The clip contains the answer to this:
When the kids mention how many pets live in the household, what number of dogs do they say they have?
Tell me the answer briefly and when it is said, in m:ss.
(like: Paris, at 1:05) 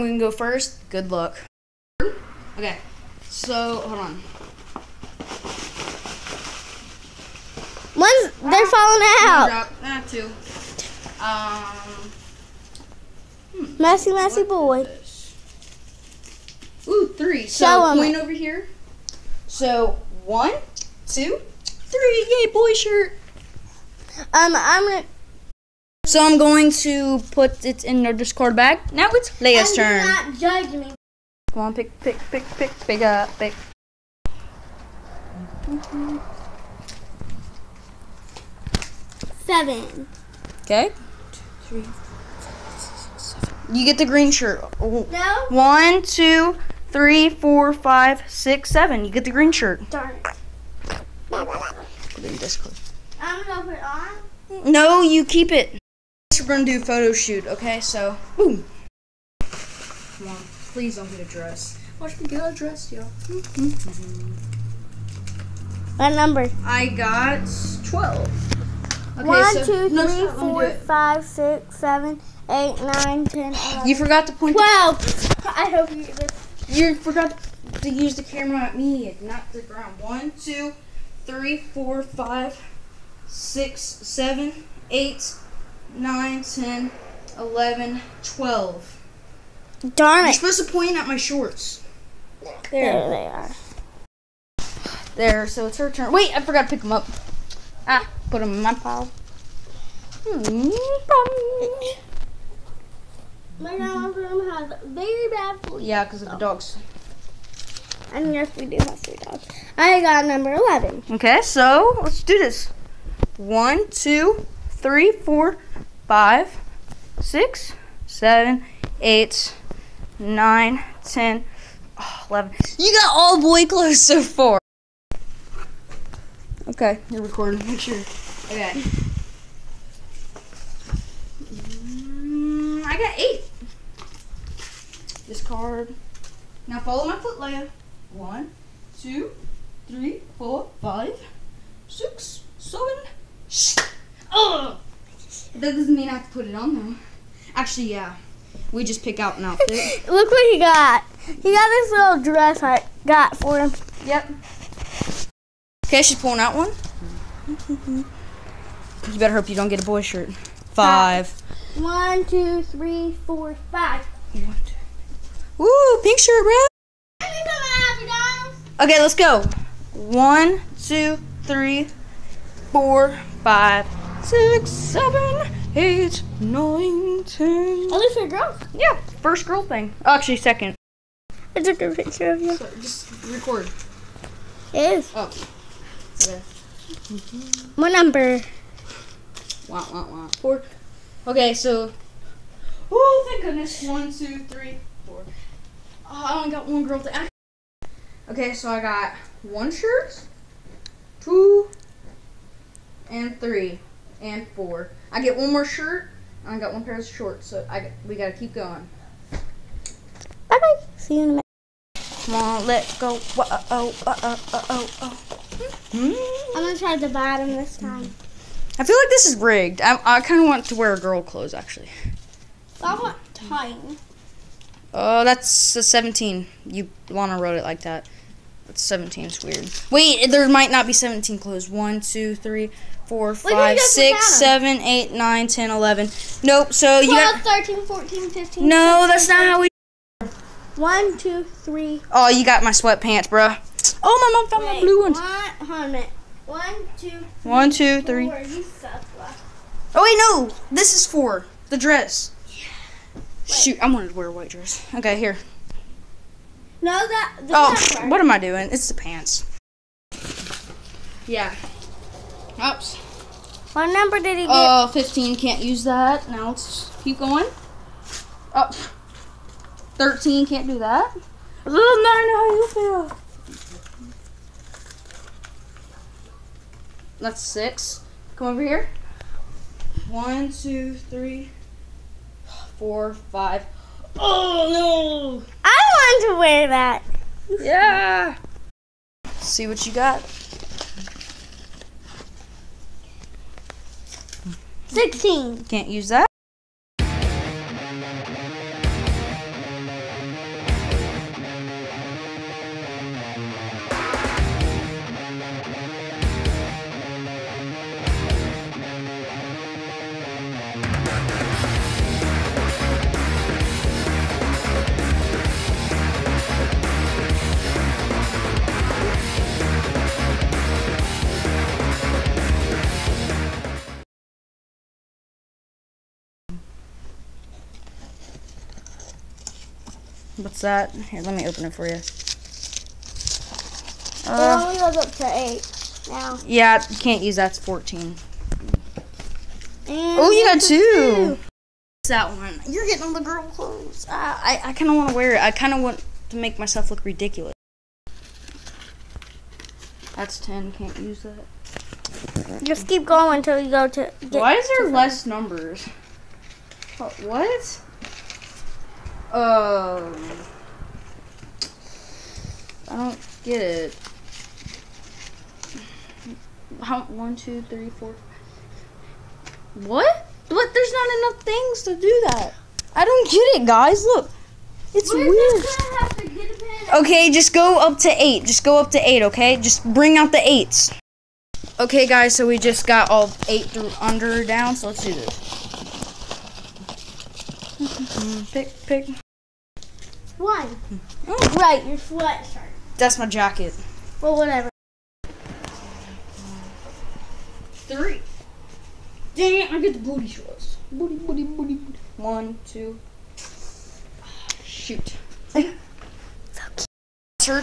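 3, at 1:49.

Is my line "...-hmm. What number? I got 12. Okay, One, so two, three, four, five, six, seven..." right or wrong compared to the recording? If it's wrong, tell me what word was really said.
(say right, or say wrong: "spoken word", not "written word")
right.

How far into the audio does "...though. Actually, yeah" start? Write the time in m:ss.
2:26.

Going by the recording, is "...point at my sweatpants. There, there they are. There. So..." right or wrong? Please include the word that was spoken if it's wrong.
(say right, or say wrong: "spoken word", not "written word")
wrong: "shorts", not "sweatpants".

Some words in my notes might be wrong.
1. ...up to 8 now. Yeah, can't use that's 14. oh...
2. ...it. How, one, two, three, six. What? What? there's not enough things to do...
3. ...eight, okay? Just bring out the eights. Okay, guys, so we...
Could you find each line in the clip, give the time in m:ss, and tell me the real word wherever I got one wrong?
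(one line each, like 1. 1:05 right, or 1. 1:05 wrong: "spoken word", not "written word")
1. 5:35 right
2. 6:03 wrong: "four", not "six"
3. 6:19 right.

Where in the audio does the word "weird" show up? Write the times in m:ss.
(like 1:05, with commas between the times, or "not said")
3:49, 6:15.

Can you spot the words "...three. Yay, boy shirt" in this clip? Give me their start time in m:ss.
0:21.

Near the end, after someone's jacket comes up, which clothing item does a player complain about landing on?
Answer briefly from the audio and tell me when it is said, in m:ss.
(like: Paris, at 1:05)
Booty shorts, at 6:39.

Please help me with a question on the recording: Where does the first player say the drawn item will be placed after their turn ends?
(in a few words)
Discard bag.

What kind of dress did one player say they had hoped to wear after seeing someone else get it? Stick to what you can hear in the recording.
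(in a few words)
White dress.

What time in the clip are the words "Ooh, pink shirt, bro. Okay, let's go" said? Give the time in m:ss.
2:45.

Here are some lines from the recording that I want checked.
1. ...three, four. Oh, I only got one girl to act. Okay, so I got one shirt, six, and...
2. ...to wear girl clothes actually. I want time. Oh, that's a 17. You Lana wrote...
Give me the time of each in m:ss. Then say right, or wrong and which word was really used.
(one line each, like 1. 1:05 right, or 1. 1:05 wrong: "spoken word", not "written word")
1. 3:14 wrong: "two", not "six"
2. 3:40 right.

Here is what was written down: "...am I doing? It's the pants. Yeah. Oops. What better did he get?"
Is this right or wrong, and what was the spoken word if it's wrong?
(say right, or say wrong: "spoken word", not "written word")
wrong: "number", not "better".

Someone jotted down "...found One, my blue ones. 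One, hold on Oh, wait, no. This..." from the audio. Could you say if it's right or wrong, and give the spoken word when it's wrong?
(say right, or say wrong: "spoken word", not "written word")
wrong: "Wait", not "One".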